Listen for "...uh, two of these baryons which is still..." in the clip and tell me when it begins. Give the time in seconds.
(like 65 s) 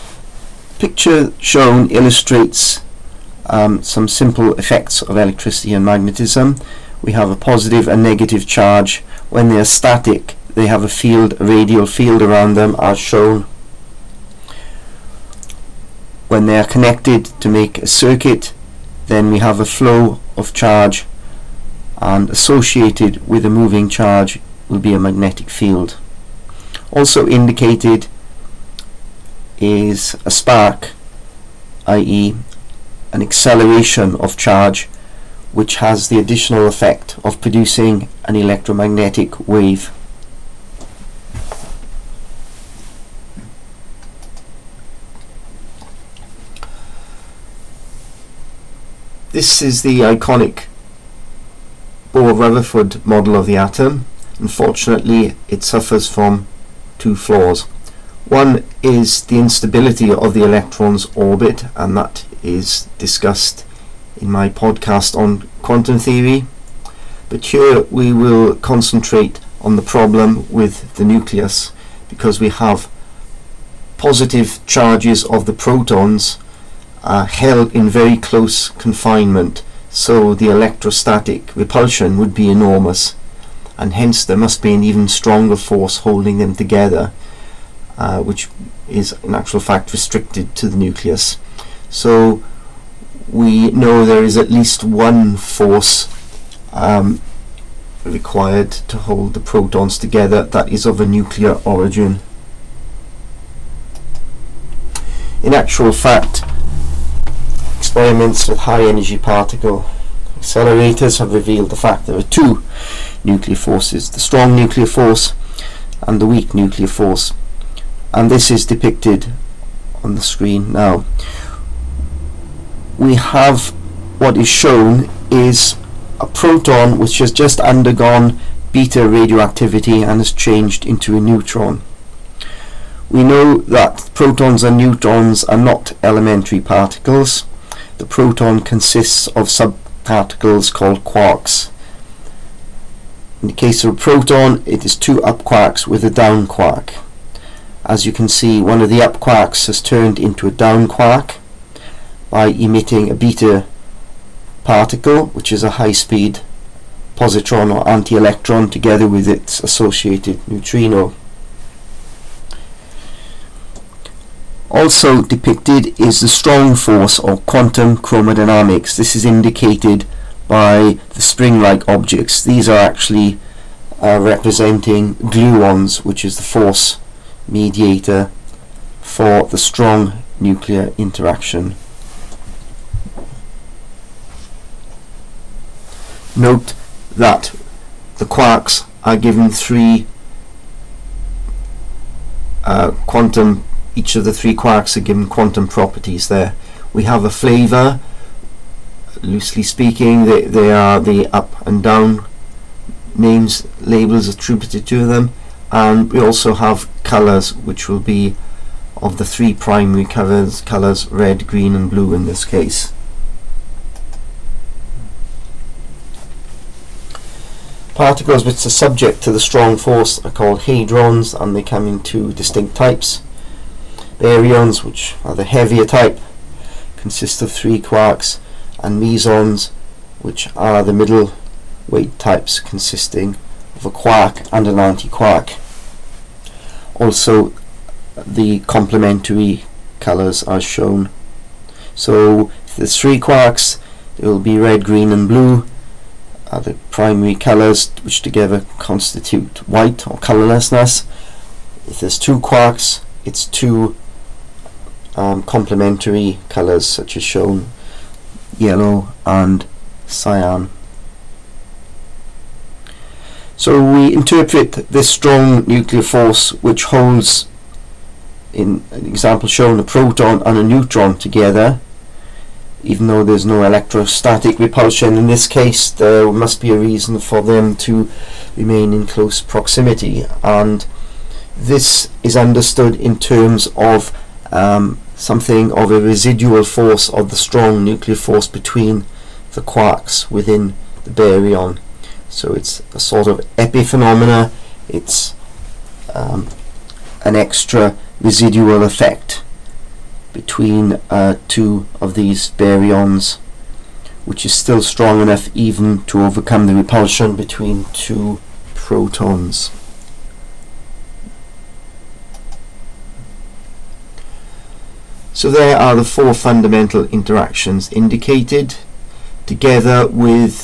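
301 s.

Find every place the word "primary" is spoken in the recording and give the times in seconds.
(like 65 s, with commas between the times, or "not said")
209 s, 246 s.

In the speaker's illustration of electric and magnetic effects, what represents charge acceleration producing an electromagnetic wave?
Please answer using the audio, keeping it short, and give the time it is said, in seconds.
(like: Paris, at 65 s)
A spark, at 30 s.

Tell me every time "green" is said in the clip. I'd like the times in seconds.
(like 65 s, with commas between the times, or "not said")
211 s, 244 s.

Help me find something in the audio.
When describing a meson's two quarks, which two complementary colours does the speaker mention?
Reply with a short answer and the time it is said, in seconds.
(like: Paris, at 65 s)
Yellow and cyan, at 258 s.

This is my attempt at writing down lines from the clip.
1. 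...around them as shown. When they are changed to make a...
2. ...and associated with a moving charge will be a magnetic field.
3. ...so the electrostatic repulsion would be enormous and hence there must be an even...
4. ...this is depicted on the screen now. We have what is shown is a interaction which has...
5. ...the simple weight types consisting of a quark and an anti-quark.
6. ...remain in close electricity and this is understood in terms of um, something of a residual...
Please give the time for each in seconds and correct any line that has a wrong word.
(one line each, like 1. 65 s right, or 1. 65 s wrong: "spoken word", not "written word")
1. 12 s wrong: "connected", not "changed"
2. 21 s right
3. 79 s right
4. 118 s wrong: "proton", not "interaction"
5. 230 s wrong: "middle", not "simple"
6. 278 s wrong: "proximity", not "electricity".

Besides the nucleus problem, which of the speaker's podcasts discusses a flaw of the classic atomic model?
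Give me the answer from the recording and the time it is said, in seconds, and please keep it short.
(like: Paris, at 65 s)
Quantum theory, at 65 s.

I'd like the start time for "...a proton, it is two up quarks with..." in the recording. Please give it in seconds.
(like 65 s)
143 s.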